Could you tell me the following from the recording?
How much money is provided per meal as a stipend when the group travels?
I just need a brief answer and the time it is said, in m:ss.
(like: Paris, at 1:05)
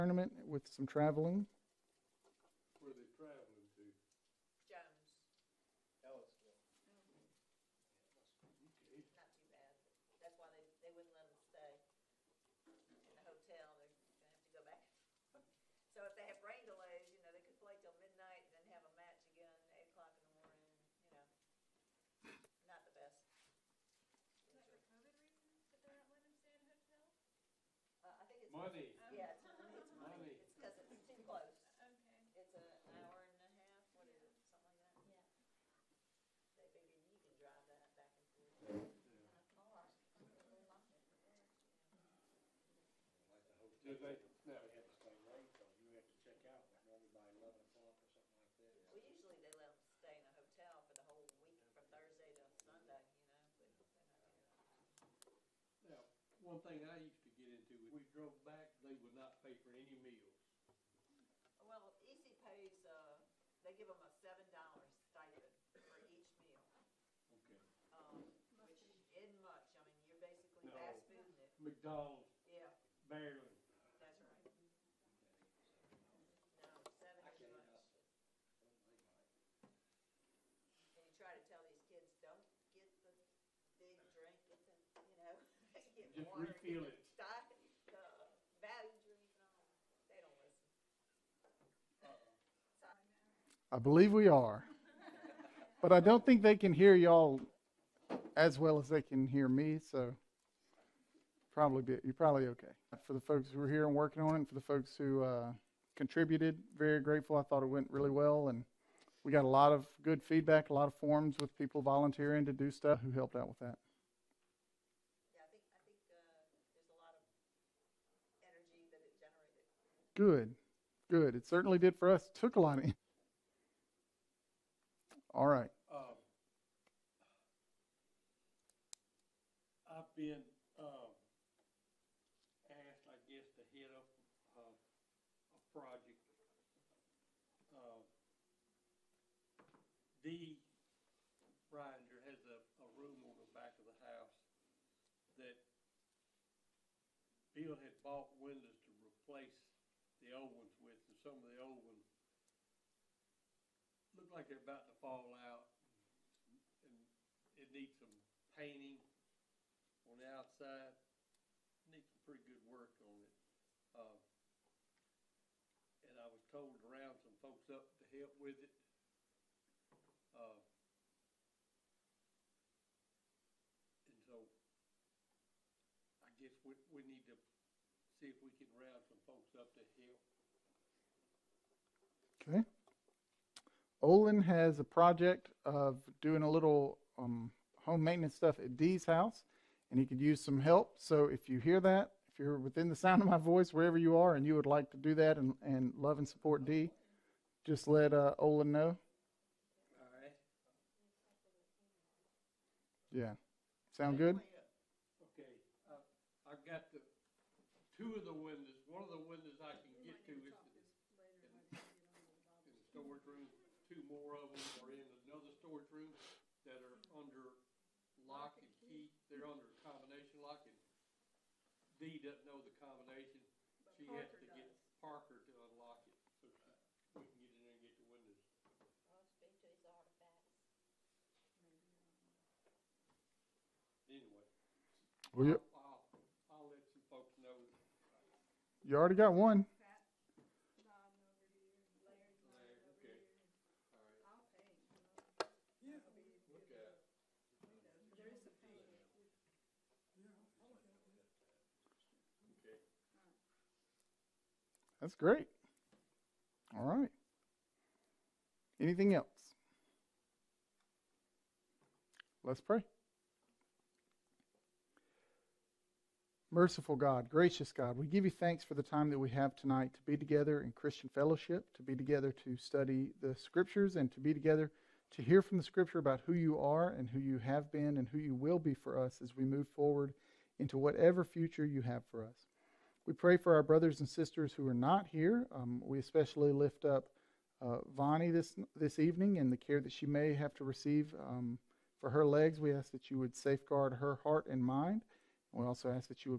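$7, at 1:04.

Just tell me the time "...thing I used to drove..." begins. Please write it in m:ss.
0:56.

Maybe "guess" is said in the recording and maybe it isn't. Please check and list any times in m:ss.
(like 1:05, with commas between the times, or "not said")
2:13, 2:56.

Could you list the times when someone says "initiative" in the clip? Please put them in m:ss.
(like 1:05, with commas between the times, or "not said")
not said.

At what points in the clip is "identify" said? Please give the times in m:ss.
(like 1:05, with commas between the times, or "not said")
not said.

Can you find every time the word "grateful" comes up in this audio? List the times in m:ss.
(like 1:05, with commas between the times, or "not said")
1:46.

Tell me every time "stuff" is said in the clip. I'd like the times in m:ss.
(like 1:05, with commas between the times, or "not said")
1:52, 3:08.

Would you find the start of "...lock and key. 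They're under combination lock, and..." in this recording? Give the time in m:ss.
3:38.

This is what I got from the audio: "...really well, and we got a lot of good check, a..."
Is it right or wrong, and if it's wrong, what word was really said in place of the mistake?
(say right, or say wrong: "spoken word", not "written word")
wrong: "feedback", not "check".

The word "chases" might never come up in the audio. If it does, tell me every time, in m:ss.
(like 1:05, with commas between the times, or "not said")
not said.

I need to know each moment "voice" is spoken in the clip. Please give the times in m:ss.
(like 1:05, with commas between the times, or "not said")
3:13.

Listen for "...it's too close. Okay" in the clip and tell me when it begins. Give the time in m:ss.
0:30.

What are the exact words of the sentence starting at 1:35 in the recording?
but I don't think they can hear y'all as well as they can hear me, so probably be, you're probably okay.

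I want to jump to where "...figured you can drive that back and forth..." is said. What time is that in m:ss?
0:36.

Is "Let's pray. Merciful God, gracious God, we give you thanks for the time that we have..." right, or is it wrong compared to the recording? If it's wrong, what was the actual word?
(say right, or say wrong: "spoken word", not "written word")
right.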